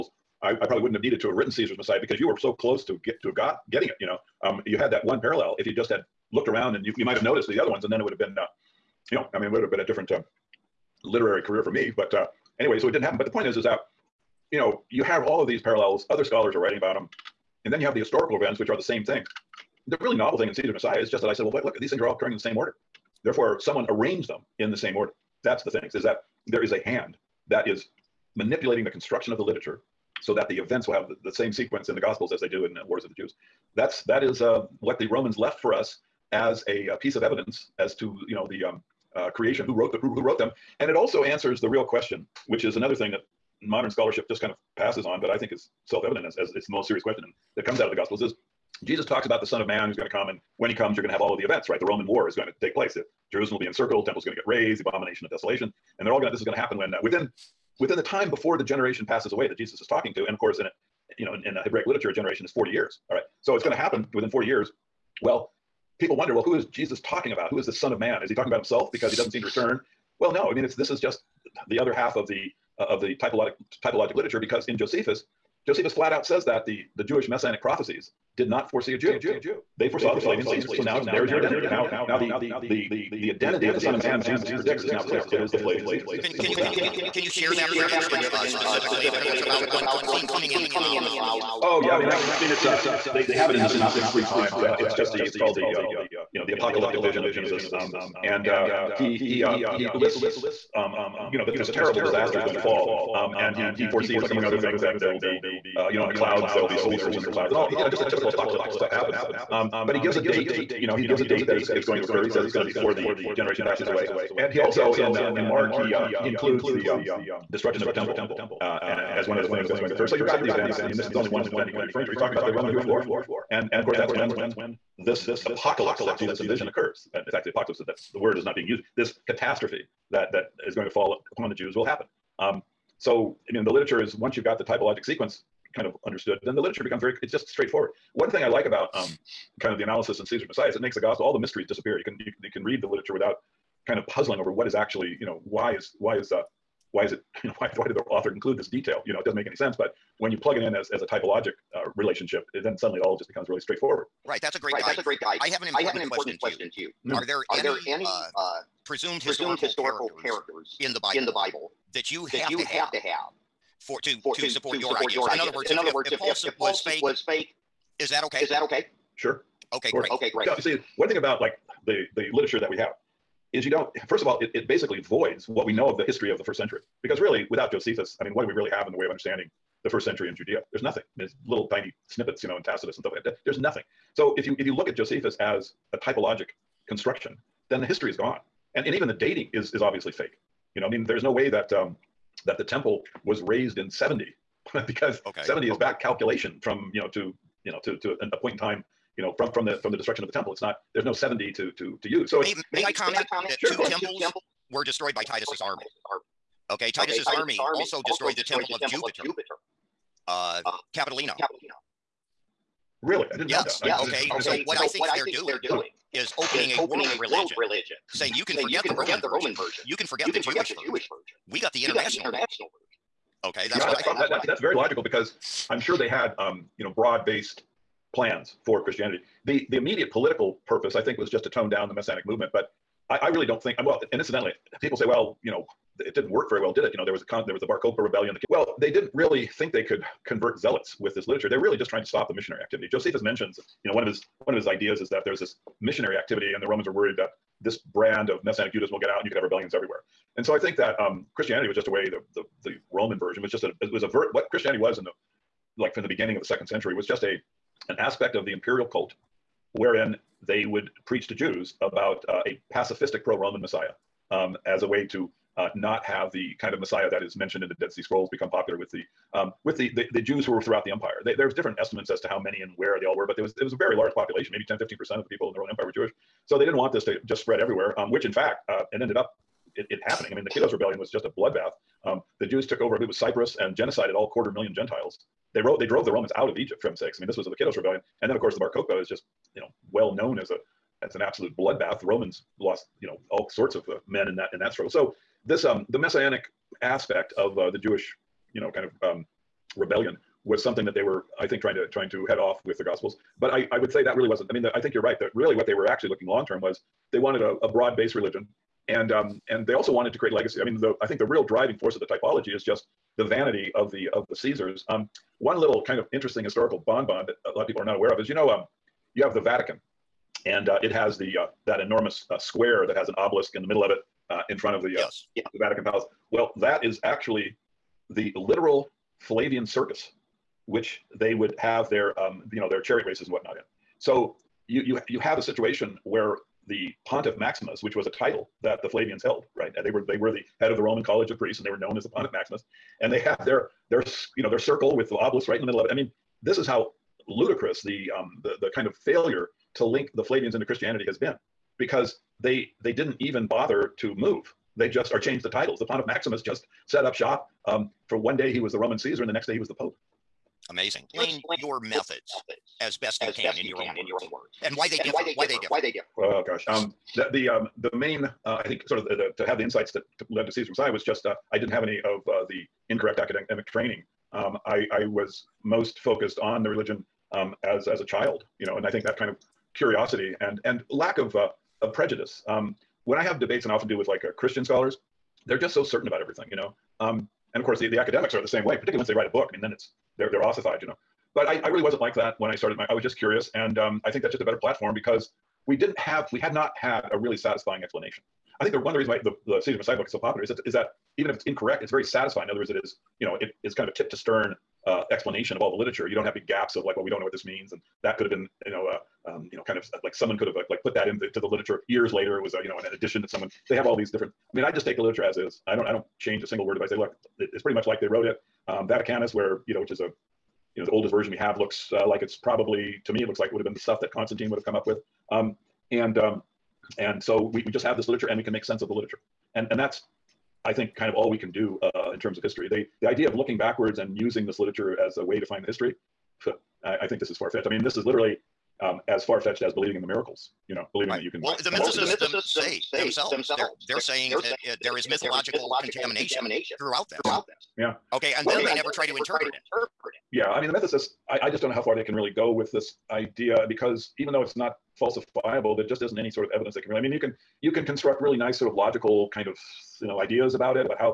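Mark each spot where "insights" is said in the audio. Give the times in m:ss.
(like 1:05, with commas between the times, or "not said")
6:09.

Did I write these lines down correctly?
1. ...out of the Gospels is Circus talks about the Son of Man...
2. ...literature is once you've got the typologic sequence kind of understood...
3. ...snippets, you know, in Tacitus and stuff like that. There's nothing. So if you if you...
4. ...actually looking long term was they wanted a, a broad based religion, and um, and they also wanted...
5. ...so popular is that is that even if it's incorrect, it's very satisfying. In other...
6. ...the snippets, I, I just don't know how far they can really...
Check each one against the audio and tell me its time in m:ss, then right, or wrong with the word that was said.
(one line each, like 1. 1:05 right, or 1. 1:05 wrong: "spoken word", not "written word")
1. 0:47 wrong: "Jesus", not "Circus"
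2. 2:13 right
3. 3:02 right
4. 5:05 right
5. 6:40 right
6. 7:30 wrong: "mythicists", not "snippets".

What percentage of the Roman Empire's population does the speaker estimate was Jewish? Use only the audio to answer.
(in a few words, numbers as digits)
10 to 15 percent.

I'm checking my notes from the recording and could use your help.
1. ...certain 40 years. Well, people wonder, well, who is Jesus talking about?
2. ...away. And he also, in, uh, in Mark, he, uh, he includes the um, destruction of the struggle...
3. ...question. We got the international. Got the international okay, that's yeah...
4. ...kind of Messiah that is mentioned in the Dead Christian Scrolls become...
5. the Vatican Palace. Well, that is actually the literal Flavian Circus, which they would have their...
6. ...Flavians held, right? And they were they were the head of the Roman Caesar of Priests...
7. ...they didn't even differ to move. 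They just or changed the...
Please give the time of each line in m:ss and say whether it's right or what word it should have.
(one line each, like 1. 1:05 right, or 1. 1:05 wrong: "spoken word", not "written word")
1. 1:04 wrong: "within", not "certain"
2. 1:53 wrong: "temple", not "struggle"
3. 3:41 wrong: "version", not "question"
4. 4:26 wrong: "Sea", not "Christian"
5. 5:25 right
6. 5:38 wrong: "College", not "Caesar"
7. 5:52 wrong: "bother", not "differ".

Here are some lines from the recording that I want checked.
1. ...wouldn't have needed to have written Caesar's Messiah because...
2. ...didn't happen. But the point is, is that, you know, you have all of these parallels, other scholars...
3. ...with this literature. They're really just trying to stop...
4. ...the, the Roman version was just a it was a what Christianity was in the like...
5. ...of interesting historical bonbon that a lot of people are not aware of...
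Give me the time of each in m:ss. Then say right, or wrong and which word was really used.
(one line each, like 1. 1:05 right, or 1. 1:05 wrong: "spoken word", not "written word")
1. 0:00 right
2. 0:12 right
3. 4:00 right
4. 4:12 right
5. 5:15 right.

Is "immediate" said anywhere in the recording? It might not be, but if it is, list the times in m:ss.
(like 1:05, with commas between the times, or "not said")
3:49.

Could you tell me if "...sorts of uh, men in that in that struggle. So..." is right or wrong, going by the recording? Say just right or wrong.
right.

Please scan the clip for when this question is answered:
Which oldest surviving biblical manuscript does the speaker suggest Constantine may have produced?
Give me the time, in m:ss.
6:58.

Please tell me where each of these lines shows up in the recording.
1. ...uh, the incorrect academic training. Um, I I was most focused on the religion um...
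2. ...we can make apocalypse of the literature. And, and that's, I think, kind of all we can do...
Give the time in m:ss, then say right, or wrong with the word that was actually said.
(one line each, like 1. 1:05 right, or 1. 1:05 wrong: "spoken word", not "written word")
1. 6:12 right
2. 7:08 wrong: "sense", not "apocalypse".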